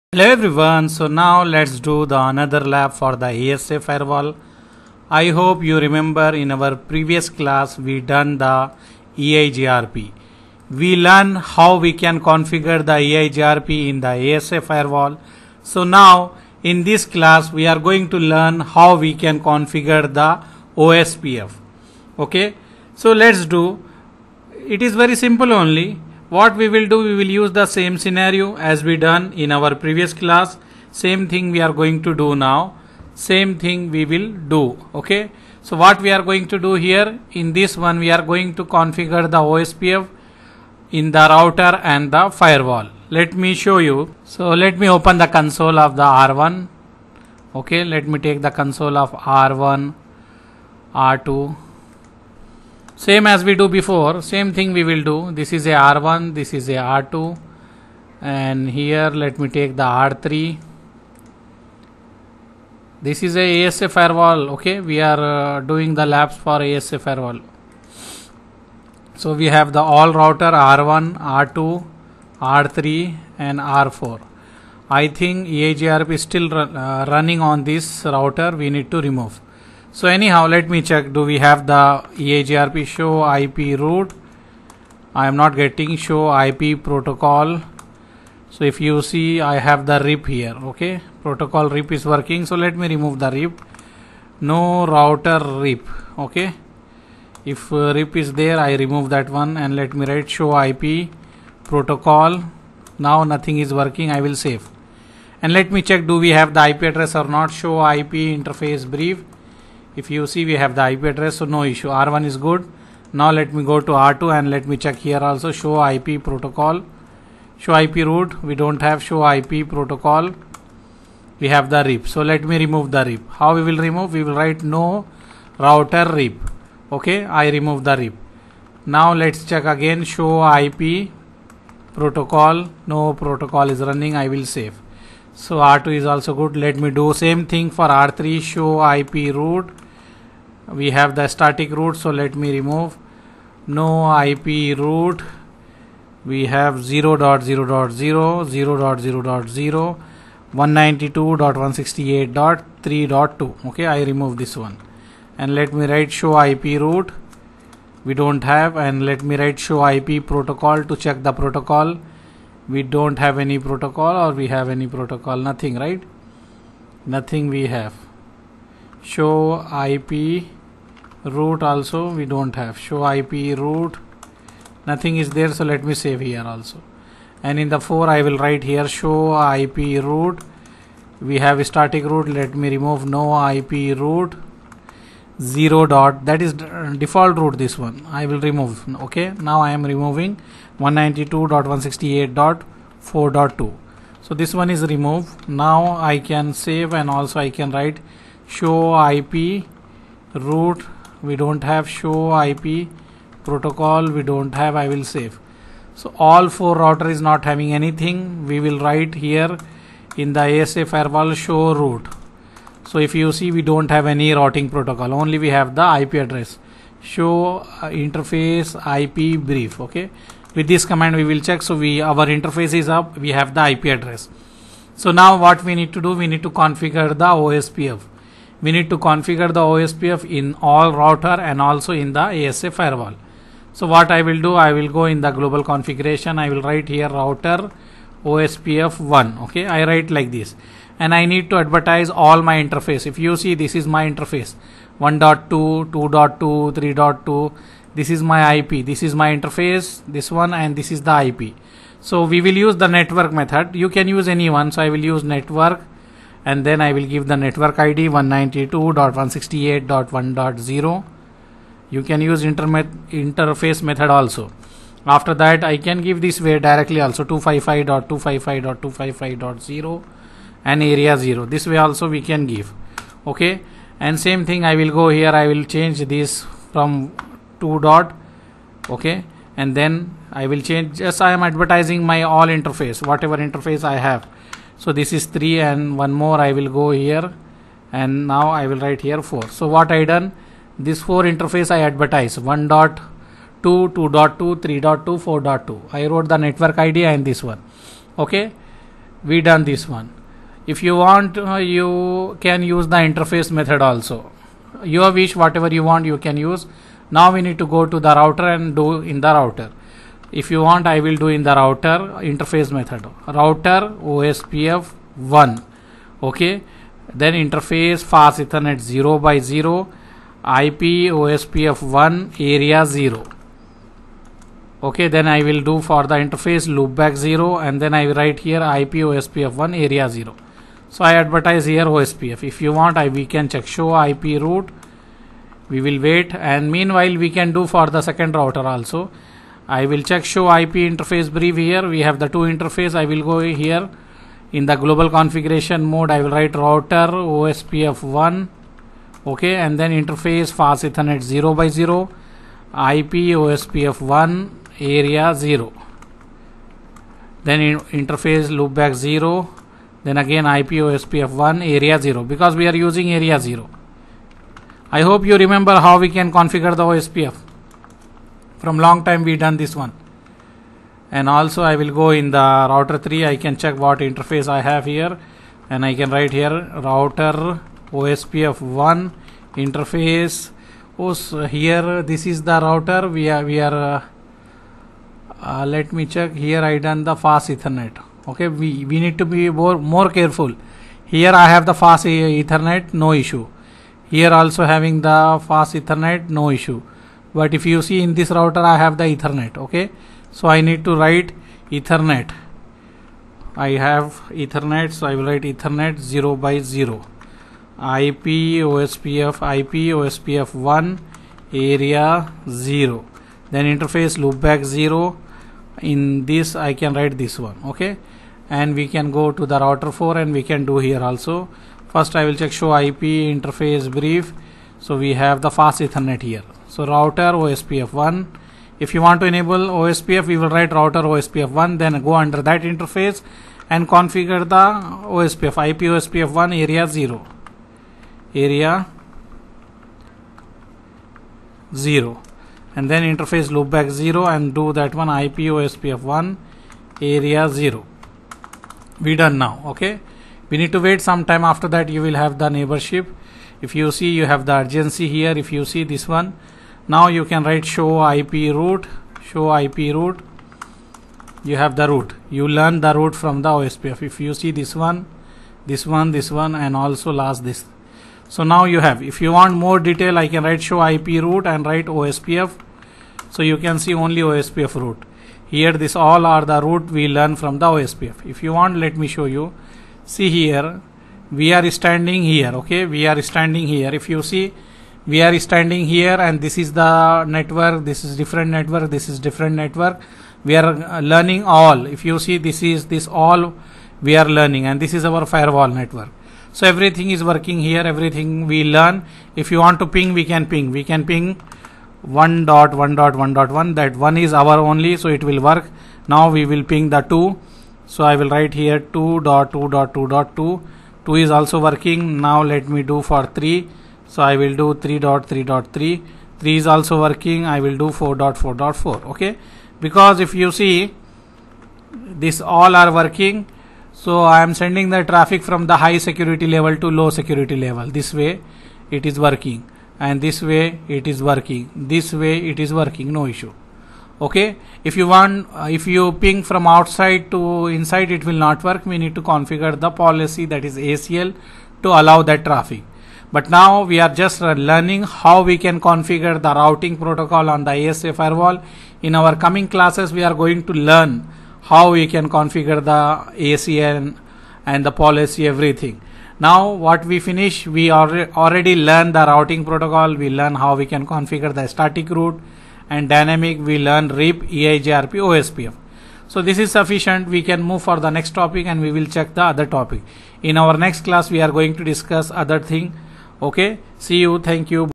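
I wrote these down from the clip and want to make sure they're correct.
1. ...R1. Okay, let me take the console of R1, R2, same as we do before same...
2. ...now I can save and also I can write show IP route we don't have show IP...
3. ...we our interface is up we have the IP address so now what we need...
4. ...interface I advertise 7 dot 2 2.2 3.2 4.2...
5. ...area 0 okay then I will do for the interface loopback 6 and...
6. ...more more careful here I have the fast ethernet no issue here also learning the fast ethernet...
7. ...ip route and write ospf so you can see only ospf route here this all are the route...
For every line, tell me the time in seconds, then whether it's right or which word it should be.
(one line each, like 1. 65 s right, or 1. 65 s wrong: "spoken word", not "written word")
1. 46 s right
2. 195 s right
3. 221 s right
4. 291 s wrong: "1", not "7"
5. 322 s wrong: "0", not "6"
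6. 389 s wrong: "having", not "learning"
7. 470 s right.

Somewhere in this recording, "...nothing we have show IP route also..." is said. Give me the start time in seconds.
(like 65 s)
167 s.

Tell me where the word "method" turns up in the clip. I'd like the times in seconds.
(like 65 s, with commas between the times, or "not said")
253 s, 263 s, 303 s, 312 s.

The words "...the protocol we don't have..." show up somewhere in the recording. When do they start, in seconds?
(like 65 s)
161 s.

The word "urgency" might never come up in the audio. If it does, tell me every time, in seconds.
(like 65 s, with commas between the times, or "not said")
454 s.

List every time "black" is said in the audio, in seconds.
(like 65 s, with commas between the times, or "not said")
not said.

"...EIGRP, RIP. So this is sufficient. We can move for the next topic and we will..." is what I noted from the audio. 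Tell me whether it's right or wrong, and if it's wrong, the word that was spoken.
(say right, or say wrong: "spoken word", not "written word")
wrong: "OSPF", not "RIP".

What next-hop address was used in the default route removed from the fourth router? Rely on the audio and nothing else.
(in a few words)
192.168.4.2.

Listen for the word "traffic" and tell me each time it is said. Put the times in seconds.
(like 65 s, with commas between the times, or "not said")
525 s, 542 s.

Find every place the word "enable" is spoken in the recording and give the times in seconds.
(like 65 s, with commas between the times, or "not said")
429 s.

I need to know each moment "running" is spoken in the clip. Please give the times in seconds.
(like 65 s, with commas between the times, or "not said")
77 s, 133 s.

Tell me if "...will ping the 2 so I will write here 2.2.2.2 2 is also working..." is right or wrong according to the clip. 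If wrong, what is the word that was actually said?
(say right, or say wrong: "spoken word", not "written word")
right.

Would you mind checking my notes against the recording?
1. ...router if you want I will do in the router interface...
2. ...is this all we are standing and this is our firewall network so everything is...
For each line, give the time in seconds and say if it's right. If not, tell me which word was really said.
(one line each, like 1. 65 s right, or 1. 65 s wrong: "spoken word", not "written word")
1. 309 s right
2. 492 s wrong: "learning", not "standing".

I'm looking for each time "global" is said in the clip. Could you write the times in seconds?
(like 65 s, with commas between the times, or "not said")
235 s, 344 s.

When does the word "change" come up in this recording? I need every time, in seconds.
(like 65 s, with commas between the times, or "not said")
275 s, 280 s.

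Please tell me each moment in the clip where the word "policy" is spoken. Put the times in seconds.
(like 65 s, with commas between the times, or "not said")
539 s, 554 s.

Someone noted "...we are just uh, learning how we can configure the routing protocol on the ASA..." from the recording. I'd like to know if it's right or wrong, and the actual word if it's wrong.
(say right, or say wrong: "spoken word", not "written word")
right.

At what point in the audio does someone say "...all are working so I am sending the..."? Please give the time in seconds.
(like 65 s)
522 s.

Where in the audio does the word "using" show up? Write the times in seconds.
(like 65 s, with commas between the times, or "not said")
362 s.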